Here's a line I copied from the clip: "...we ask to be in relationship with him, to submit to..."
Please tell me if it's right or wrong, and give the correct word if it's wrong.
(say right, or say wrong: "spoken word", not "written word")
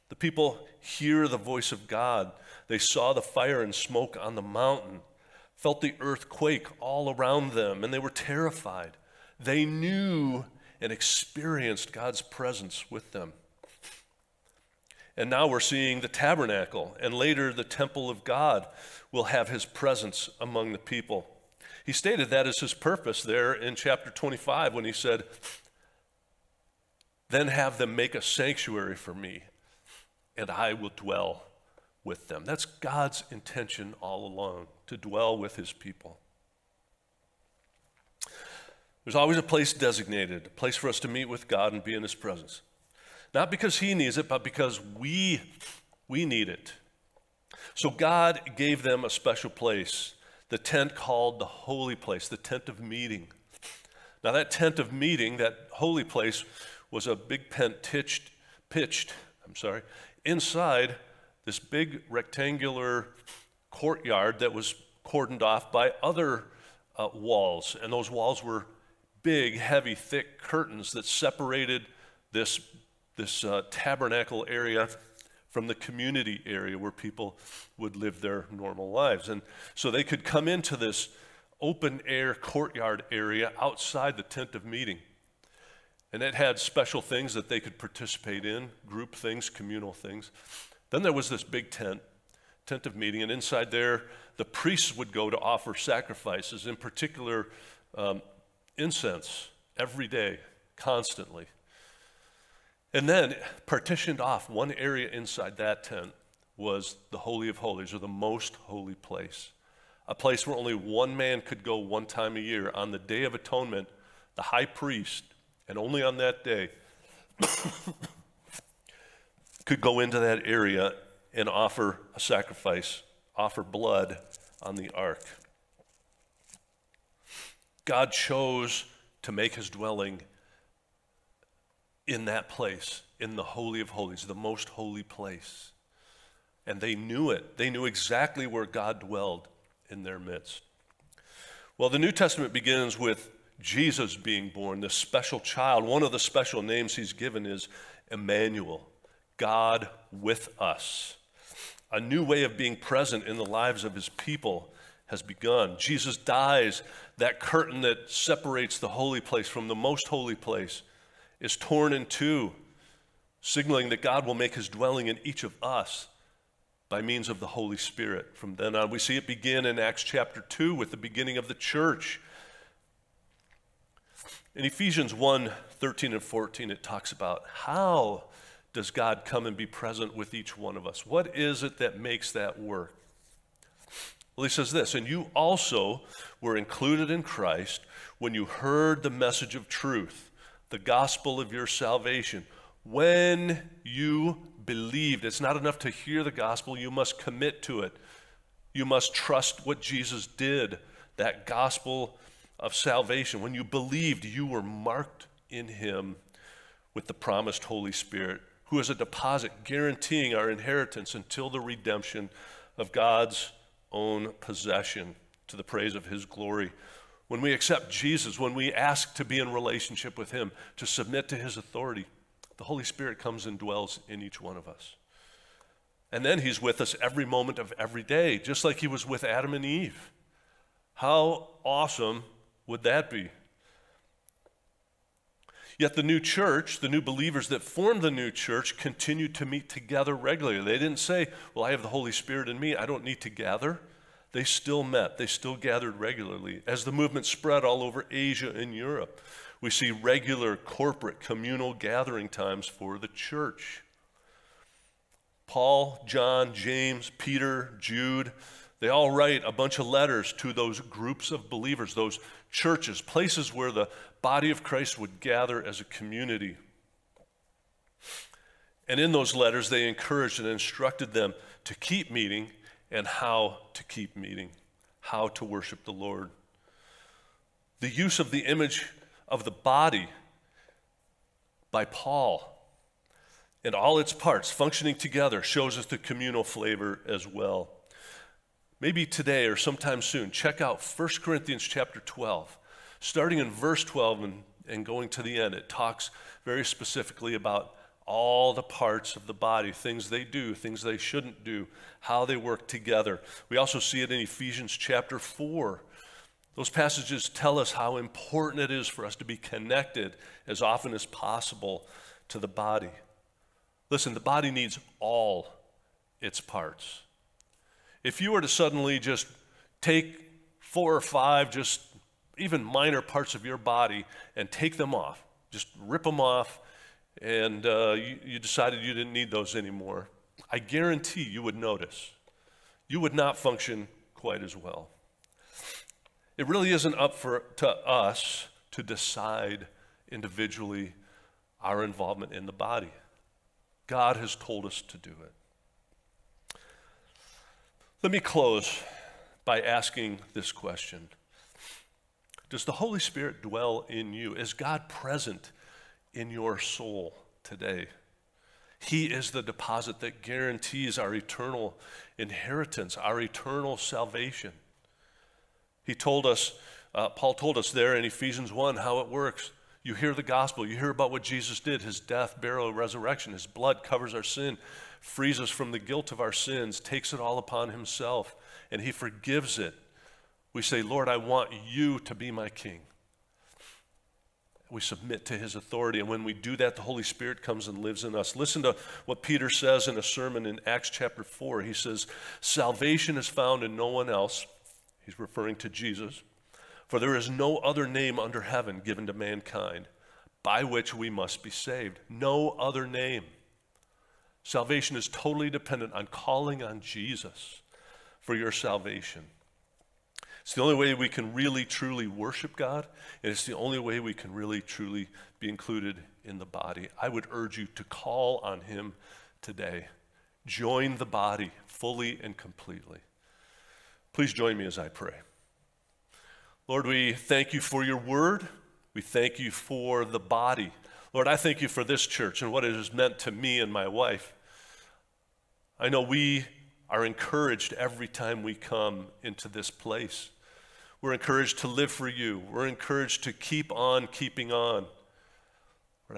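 right.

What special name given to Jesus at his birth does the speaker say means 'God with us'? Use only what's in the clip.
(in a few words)
Emmanuel.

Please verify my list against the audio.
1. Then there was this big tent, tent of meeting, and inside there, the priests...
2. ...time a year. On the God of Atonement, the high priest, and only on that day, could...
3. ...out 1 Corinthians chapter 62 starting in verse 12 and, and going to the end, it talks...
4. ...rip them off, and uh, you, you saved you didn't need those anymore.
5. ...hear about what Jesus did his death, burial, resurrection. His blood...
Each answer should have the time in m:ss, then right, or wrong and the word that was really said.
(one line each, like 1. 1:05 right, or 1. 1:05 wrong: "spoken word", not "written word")
1. 1:30 right
2. 1:52 wrong: "Day", not "God"
3. 4:50 wrong: "12", not "62"
4. 5:25 wrong: "decided", not "saved"
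5. 6:10 right.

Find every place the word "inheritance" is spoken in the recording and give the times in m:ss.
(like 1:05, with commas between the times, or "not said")
3:30, 6:02.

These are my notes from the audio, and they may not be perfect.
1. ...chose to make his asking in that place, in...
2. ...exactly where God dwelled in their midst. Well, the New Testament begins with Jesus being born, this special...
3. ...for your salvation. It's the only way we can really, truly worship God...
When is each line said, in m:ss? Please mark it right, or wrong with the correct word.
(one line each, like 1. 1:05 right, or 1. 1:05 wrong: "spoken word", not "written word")
1. 2:08 wrong: "dwelling", not "asking"
2. 2:17 right
3. 6:48 right.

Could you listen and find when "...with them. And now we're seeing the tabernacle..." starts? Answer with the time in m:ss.
0:12.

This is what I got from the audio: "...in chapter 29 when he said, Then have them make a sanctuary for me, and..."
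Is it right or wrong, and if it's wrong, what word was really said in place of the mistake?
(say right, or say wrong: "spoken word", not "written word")
wrong: "25", not "29".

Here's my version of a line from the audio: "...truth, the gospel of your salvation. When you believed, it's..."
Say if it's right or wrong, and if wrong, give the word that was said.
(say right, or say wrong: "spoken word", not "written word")
right.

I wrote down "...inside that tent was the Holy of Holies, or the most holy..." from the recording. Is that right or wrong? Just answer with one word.
right.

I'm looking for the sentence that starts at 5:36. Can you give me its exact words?
It really isn't up for, to us to decide individually our involvement in the body.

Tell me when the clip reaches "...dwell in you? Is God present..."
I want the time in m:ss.
5:53.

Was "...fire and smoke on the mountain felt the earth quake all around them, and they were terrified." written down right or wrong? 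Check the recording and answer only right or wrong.
right.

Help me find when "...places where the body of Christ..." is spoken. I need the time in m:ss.
4:23.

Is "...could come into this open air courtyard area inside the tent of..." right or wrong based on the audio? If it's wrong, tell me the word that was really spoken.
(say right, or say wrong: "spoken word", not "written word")
wrong: "outside", not "inside".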